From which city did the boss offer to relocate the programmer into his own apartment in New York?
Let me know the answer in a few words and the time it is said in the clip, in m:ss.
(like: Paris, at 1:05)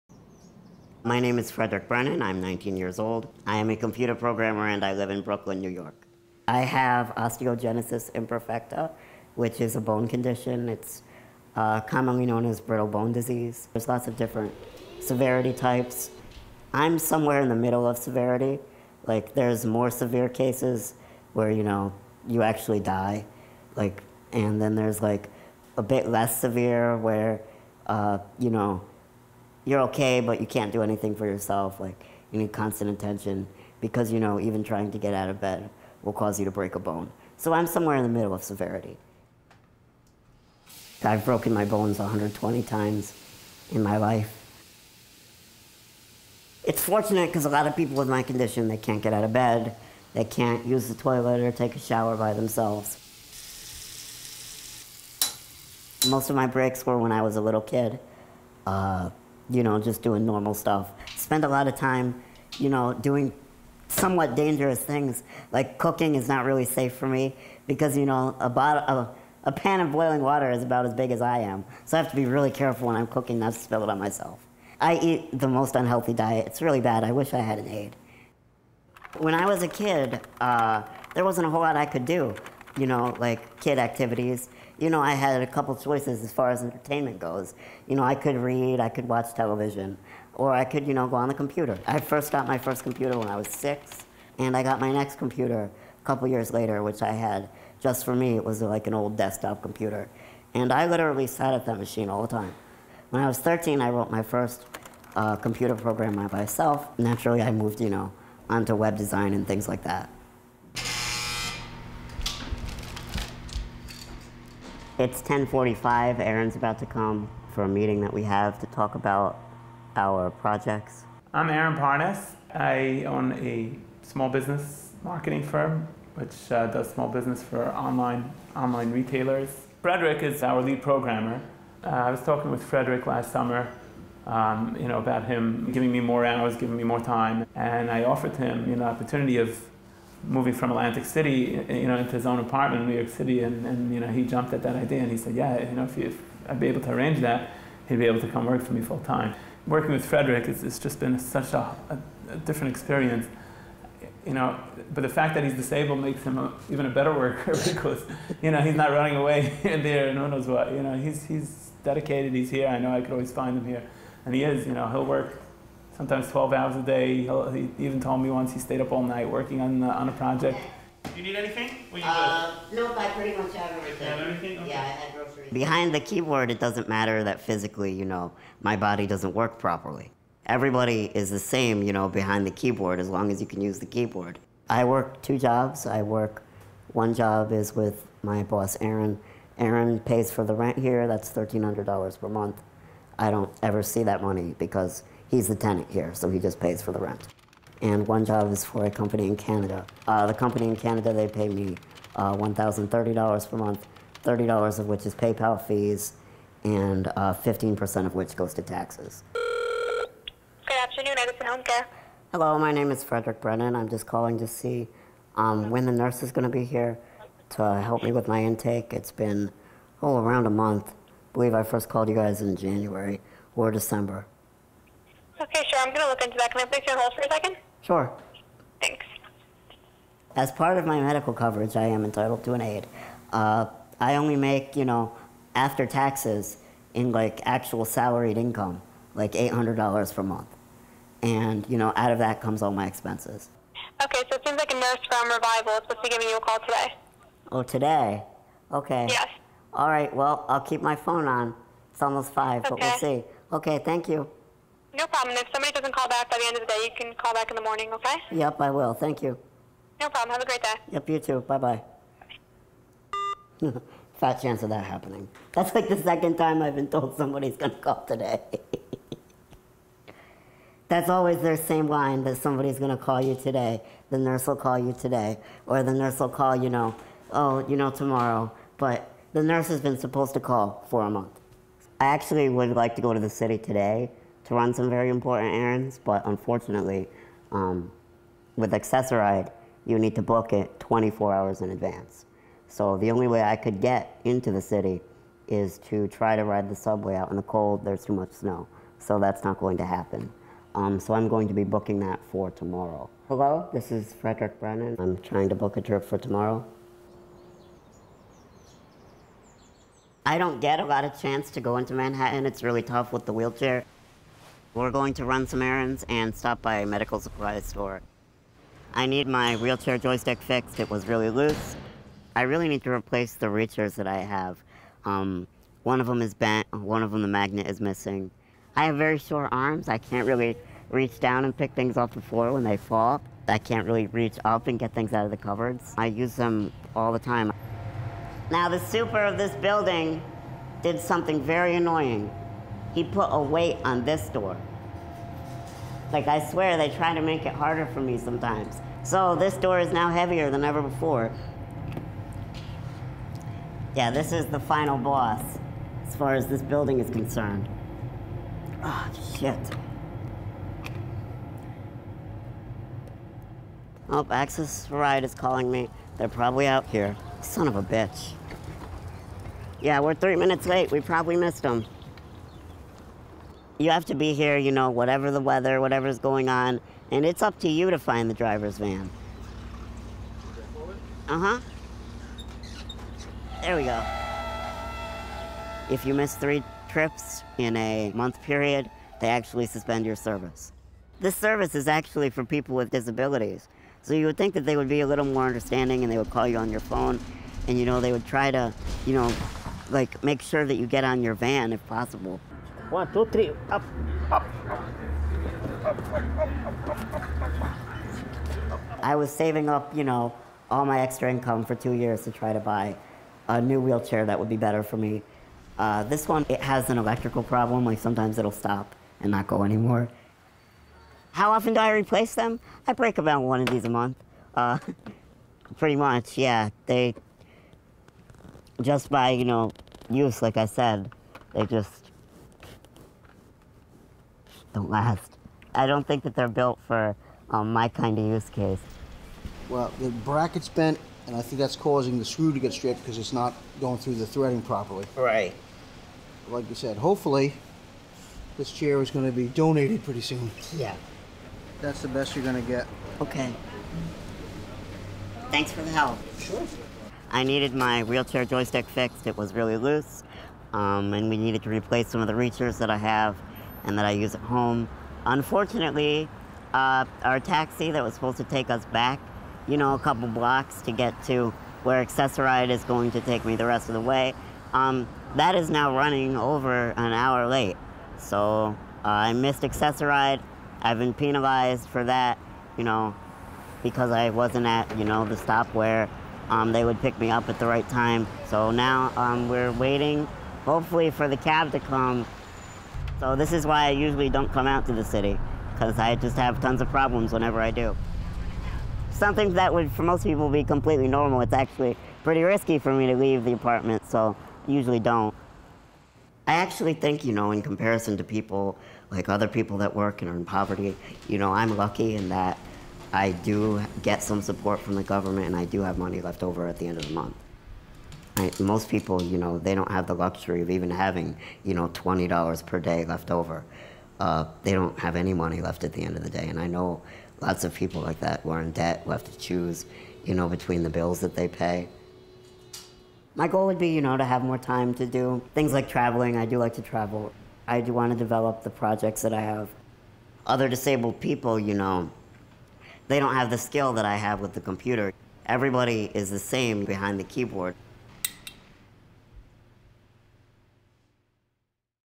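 Atlantic City, at 2:20.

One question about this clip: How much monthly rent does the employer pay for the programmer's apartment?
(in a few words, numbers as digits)
$1,300.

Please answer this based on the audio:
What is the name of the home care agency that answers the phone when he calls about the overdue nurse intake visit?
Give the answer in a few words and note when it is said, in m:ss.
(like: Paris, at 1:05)
Edison Home Care, at 3:31.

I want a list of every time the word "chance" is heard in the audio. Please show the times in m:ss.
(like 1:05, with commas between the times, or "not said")
4:24, 5:11.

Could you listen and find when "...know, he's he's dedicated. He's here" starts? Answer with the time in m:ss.
2:40.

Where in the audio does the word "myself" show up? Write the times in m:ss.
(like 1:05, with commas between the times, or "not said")
1:13, 1:46.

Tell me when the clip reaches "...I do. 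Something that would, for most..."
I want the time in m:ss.
8:17.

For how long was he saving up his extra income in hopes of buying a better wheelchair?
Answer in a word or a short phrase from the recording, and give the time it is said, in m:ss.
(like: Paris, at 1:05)
2 years, at 6:51.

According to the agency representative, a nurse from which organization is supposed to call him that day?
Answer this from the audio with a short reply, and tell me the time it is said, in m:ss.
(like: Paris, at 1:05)
Revival, at 4:05.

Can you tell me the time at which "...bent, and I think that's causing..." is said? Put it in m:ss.
7:20.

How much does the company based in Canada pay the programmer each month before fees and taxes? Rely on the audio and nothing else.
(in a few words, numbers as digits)
$1,030.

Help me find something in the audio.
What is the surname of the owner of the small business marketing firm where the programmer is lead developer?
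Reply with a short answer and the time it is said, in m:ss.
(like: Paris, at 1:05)
Parnas, at 2:01.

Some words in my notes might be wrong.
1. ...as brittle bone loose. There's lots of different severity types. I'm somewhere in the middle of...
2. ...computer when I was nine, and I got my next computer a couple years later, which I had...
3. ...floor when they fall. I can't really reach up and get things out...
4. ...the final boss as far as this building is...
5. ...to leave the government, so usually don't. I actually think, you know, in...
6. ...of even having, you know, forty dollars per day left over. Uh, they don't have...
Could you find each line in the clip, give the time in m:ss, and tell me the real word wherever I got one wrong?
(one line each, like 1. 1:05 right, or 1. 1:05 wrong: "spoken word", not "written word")
1. 0:12 wrong: "disease", not "loose"
2. 1:32 wrong: "six", not "nine"
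3. 5:32 right
4. 5:54 right
5. 8:23 wrong: "apartment", not "government"
6. 8:40 wrong: "twenty", not "forty".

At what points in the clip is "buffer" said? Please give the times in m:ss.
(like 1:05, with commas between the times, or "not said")
not said.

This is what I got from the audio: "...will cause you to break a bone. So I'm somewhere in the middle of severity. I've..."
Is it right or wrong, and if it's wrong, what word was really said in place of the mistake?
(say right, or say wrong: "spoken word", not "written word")
right.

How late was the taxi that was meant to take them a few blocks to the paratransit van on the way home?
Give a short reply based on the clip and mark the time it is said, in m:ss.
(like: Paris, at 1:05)
over an hour, at 7:56.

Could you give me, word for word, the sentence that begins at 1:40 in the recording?
And I literally sat at that machine all the time.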